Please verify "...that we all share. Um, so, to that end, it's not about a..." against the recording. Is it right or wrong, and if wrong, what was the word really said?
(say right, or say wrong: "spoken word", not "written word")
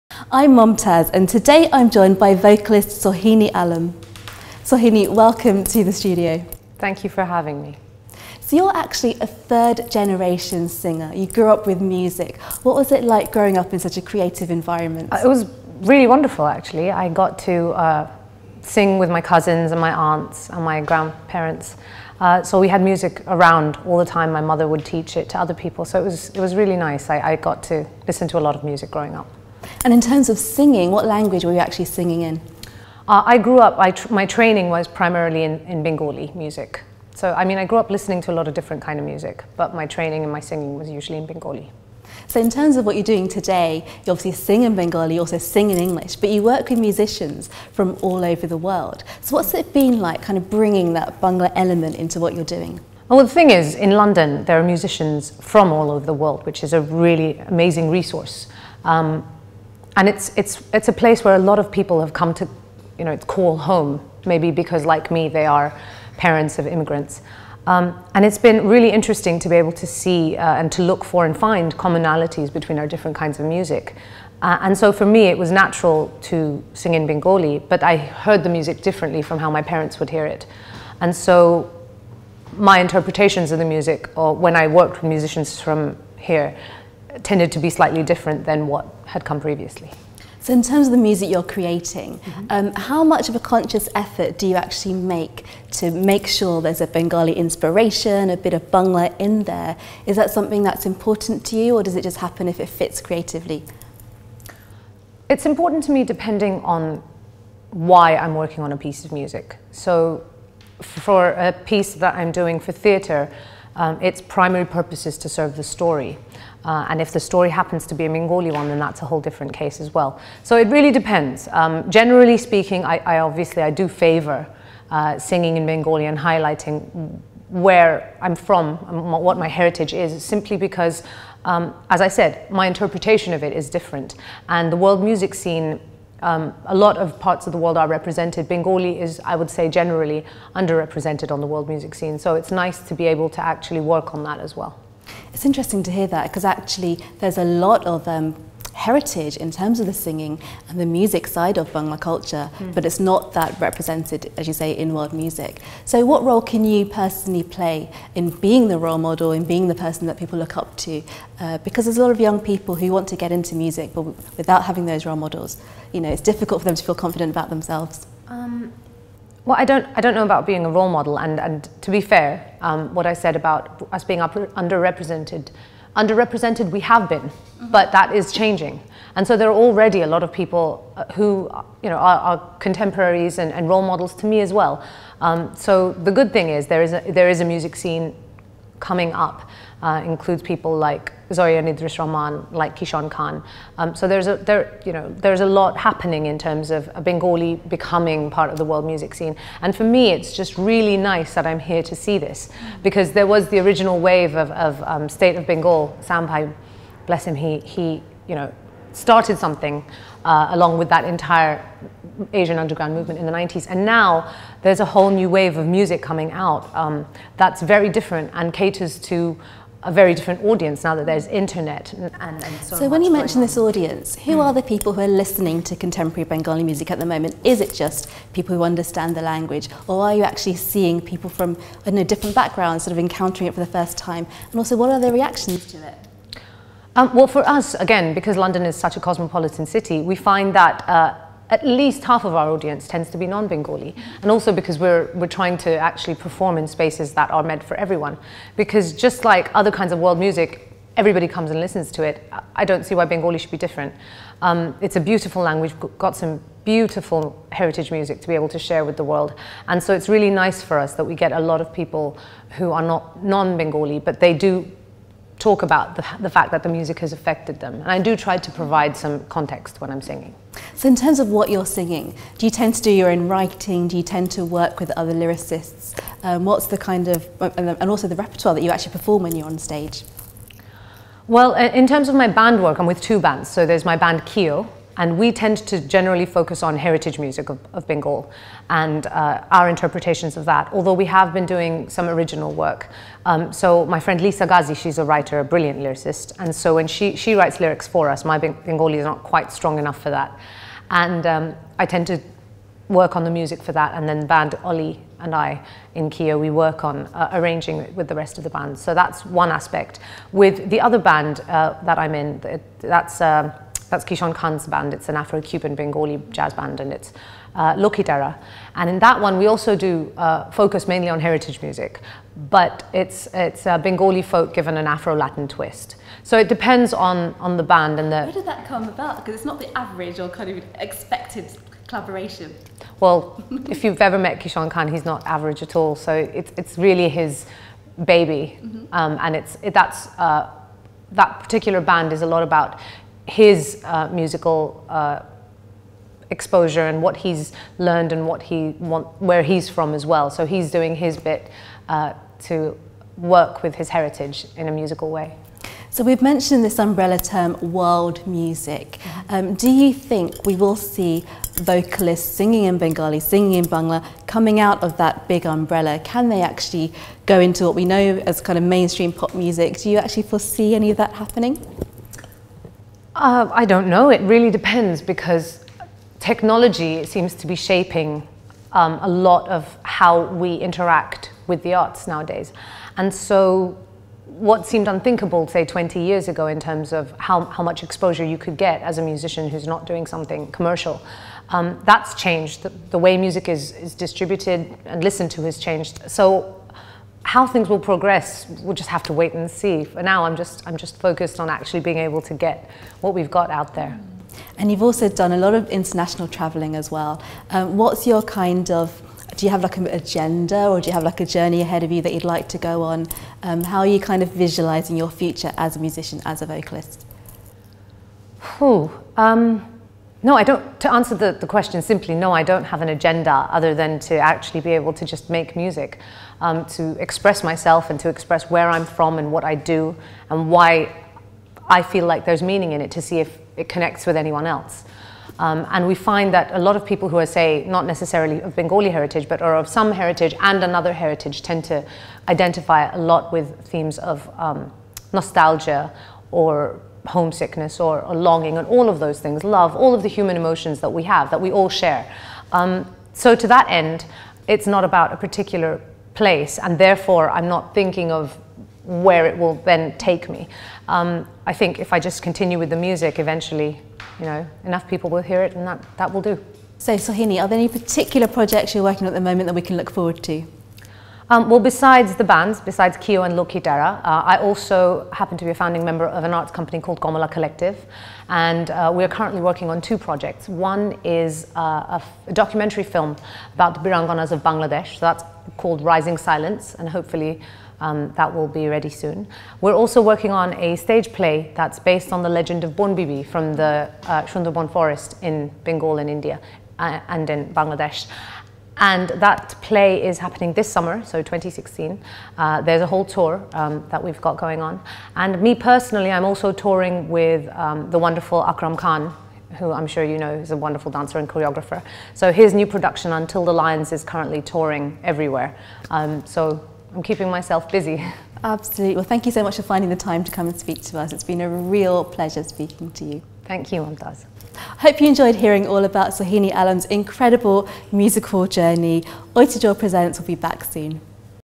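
right.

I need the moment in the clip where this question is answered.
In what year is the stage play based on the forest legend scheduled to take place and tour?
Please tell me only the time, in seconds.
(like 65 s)
501 s.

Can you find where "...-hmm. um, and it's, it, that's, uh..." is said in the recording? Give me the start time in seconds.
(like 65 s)
338 s.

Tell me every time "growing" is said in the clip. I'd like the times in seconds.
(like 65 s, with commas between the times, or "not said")
13 s, 28 s.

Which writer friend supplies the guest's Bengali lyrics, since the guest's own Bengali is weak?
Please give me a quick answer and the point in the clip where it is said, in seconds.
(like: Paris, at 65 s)
Leesa Gazi, at 294 s.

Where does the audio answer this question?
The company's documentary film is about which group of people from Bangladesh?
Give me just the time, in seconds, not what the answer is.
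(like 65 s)
483 s.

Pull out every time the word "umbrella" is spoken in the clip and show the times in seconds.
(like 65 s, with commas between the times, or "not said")
356 s, 365 s.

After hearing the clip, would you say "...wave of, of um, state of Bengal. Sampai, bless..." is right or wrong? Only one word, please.
right.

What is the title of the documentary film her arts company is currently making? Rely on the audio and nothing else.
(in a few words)
Rising Silence.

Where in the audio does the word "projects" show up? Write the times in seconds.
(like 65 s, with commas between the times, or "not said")
468 s, 479 s.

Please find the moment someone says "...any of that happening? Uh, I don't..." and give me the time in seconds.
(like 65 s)
370 s.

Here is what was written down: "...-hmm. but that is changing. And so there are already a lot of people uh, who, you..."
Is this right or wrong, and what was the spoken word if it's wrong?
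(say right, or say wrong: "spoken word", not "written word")
right.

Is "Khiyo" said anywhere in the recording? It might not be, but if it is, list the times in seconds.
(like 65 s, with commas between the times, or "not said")
284 s, 306 s, 472 s.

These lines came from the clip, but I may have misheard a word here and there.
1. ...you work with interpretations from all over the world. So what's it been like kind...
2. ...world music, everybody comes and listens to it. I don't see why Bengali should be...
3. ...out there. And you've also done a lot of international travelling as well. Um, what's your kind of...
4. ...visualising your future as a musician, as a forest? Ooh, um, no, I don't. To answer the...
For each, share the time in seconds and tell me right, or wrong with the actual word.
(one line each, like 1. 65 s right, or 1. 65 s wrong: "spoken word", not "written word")
1. 46 s wrong: "musicians", not "interpretations"
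2. 249 s right
3. 403 s right
4. 414 s wrong: "vocalist", not "forest".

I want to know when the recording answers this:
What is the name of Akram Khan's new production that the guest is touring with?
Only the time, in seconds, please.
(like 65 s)
513 s.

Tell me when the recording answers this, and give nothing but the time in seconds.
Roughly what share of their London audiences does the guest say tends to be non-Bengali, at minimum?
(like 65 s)
242 s.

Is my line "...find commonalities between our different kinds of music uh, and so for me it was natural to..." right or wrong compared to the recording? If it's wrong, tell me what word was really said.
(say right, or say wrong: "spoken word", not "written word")
right.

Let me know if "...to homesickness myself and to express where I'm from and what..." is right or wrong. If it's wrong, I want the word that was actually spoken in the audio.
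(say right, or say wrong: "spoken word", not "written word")
wrong: "express", not "homesickness".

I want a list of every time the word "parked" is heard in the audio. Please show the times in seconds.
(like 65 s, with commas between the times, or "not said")
not said.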